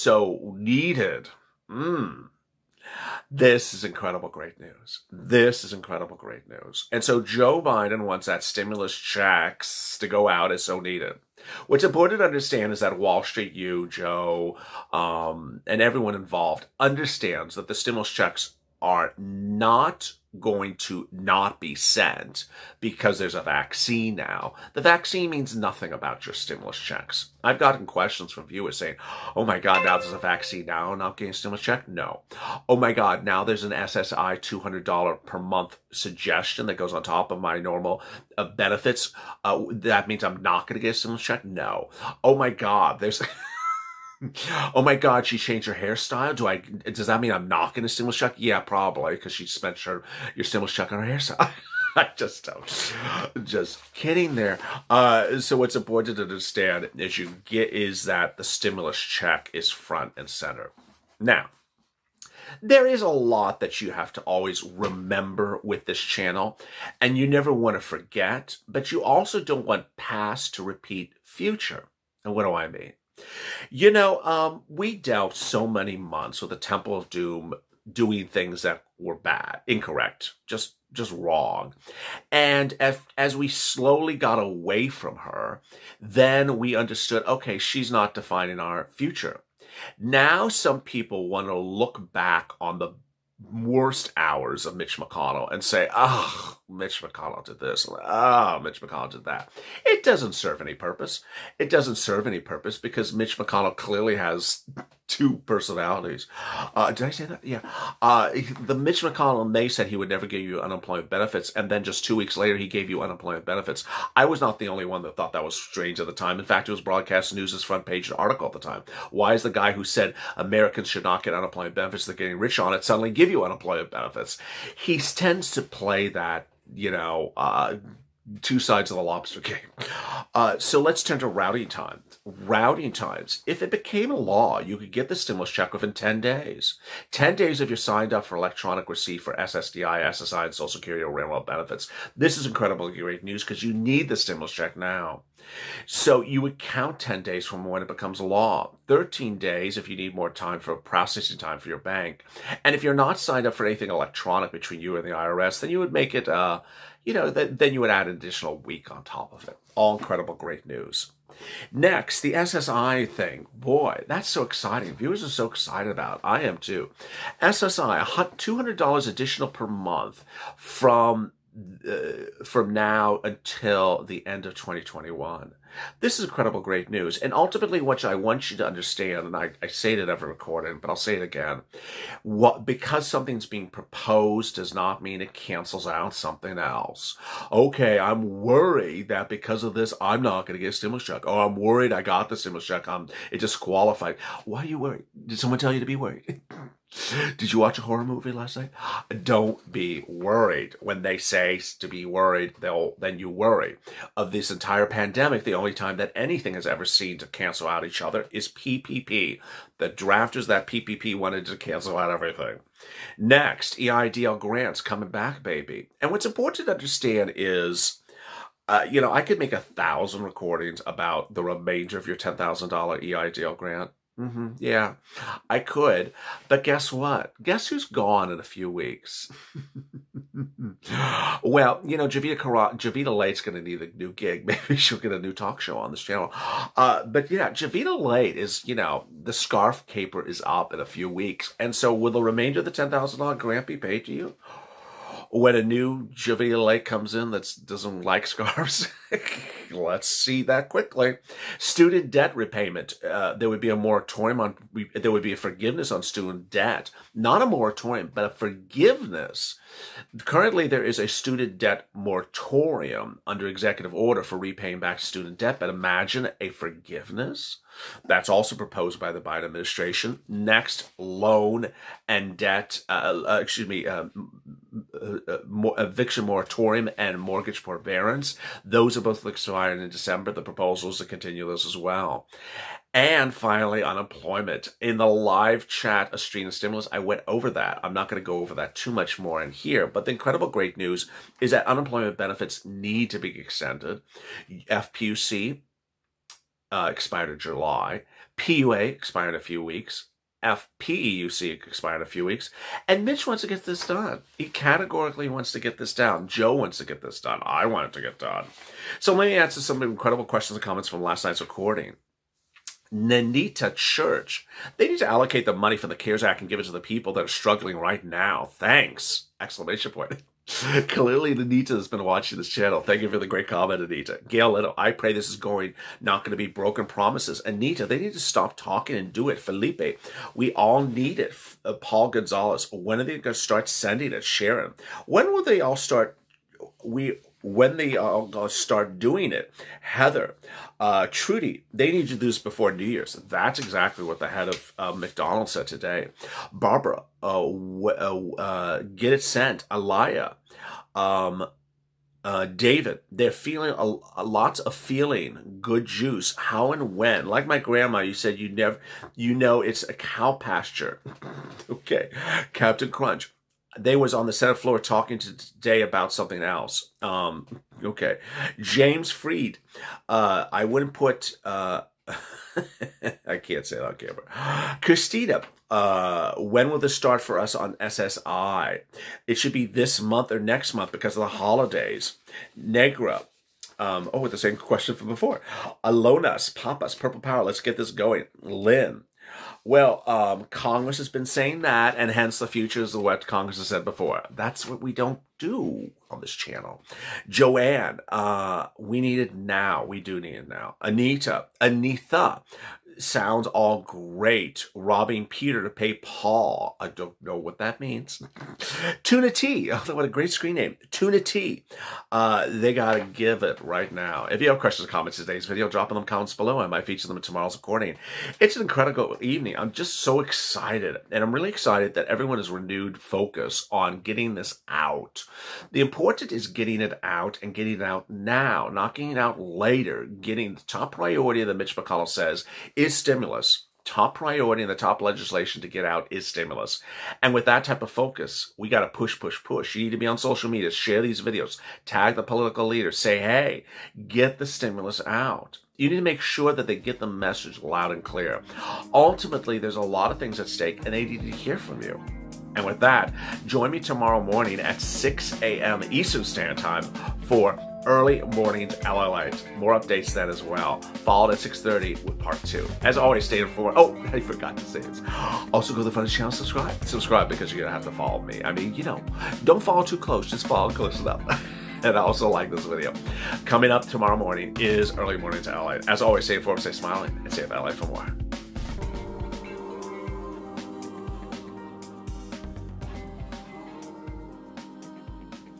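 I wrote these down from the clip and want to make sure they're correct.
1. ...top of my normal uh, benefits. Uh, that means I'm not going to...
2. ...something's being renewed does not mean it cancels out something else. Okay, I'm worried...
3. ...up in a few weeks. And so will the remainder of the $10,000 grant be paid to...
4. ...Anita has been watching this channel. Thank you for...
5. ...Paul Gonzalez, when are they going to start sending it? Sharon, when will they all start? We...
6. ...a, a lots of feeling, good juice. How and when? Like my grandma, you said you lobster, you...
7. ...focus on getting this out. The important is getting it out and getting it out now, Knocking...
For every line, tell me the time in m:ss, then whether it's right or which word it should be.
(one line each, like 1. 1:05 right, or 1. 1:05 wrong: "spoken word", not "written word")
1. 0:37 right
2. 3:03 wrong: "proposed", not "renewed"
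3. 4:00 right
4. 5:21 right
5. 5:31 right
6. 5:53 wrong: "never", not "lobster"
7. 7:03 right.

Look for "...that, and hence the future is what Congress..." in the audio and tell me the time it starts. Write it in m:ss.
6:31.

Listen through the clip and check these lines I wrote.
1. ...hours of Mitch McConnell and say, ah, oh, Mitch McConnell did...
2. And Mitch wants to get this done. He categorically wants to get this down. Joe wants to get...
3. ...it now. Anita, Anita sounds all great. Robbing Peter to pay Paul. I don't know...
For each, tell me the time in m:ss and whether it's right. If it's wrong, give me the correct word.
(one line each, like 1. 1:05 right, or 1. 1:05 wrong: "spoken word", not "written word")
1. 1:34 right
2. 5:02 right
3. 6:40 right.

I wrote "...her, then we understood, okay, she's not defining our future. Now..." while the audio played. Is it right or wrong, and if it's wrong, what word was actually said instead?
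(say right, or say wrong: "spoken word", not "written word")
right.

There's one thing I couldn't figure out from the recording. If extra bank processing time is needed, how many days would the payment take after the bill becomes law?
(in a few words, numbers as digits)
13 days.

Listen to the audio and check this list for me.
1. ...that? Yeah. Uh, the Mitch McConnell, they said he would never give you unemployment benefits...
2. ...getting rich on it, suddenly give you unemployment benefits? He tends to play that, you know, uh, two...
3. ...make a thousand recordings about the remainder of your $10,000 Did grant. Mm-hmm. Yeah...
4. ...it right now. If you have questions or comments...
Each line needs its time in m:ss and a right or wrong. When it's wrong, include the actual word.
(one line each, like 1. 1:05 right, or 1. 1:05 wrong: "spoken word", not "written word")
1. 1:47 right
2. 2:02 right
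3. 3:39 wrong: "EIDL", not "Did"
4. 6:53 right.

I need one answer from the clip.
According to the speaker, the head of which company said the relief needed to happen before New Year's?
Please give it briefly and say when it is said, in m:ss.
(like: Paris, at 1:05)
McDonald's, at 5:44.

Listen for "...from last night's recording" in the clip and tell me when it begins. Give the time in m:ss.
5:10.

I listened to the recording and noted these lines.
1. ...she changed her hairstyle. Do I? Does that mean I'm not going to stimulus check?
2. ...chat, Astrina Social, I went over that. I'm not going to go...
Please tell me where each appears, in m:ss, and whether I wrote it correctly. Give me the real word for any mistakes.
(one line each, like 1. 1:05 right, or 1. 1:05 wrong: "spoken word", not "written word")
1. 0:45 right
2. 4:45 wrong: "Stimulus", not "Social".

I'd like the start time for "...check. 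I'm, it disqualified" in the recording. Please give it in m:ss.
3:12.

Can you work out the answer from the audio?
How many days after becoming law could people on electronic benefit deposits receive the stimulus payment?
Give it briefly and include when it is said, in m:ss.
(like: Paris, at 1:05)
10 days, at 2:15.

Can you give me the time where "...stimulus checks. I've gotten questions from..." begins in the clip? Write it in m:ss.
0:26.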